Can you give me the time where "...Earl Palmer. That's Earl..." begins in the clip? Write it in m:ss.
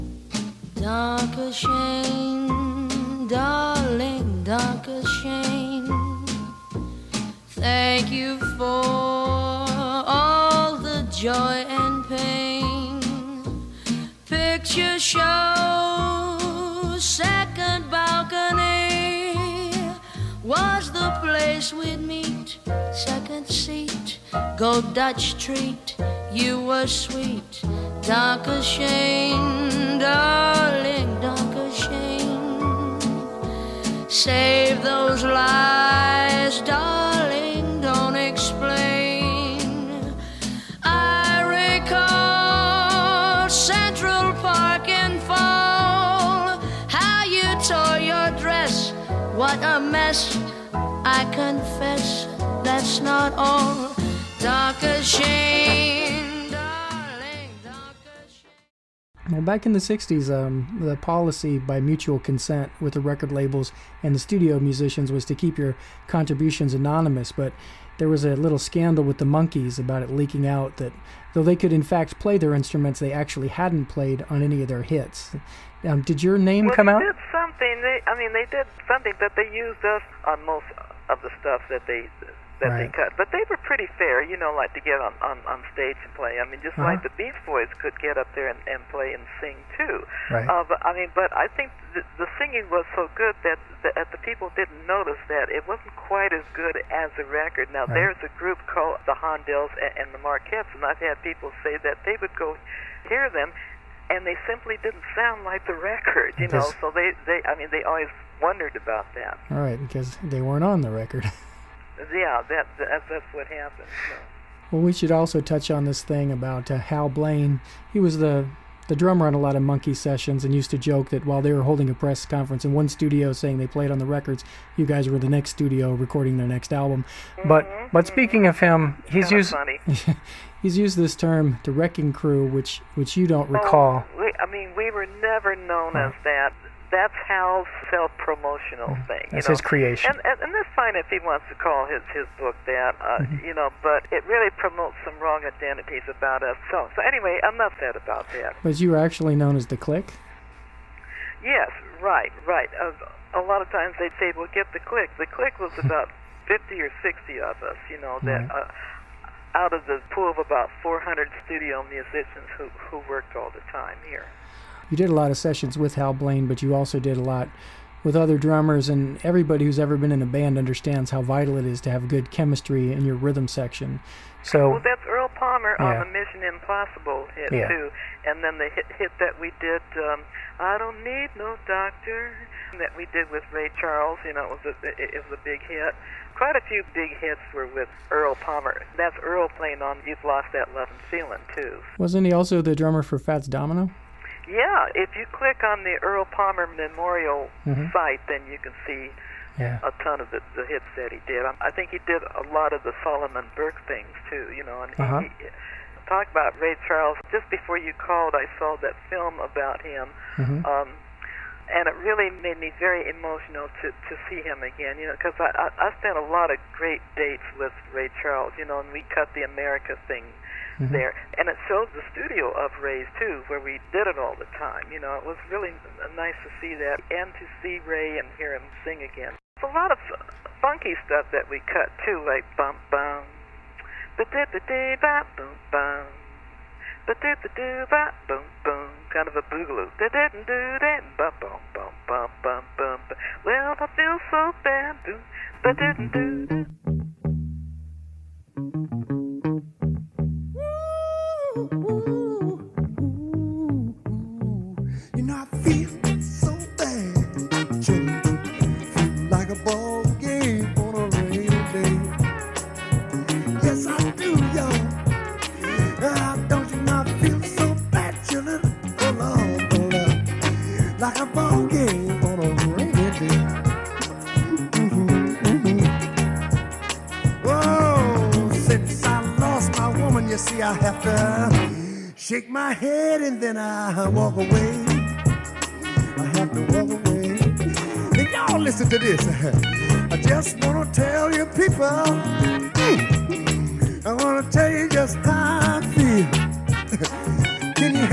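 3:08.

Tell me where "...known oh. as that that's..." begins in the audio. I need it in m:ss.
2:15.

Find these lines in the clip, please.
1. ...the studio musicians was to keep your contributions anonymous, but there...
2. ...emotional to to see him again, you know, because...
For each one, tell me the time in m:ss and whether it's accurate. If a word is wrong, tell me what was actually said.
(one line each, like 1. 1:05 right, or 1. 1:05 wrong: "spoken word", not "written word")
1. 1:04 right
2. 3:33 right.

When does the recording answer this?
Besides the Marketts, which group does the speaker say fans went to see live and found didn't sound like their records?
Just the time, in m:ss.
1:39.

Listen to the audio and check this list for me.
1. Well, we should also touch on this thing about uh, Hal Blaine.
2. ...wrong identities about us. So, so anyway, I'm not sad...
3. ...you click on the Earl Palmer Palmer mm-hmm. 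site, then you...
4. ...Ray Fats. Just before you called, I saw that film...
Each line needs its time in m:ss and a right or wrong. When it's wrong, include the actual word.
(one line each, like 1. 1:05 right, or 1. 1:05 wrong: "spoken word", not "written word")
1. 1:54 right
2. 2:25 right
3. 3:15 wrong: "Memorial", not "Palmer"
4. 3:26 wrong: "Charles", not "Fats".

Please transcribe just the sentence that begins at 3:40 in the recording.
there, and it showed the studio of Ray's too, where we did it all the time.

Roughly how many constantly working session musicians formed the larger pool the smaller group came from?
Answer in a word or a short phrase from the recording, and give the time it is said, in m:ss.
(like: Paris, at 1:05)
400, at 2:40.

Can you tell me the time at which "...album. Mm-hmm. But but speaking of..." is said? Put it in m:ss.
2:06.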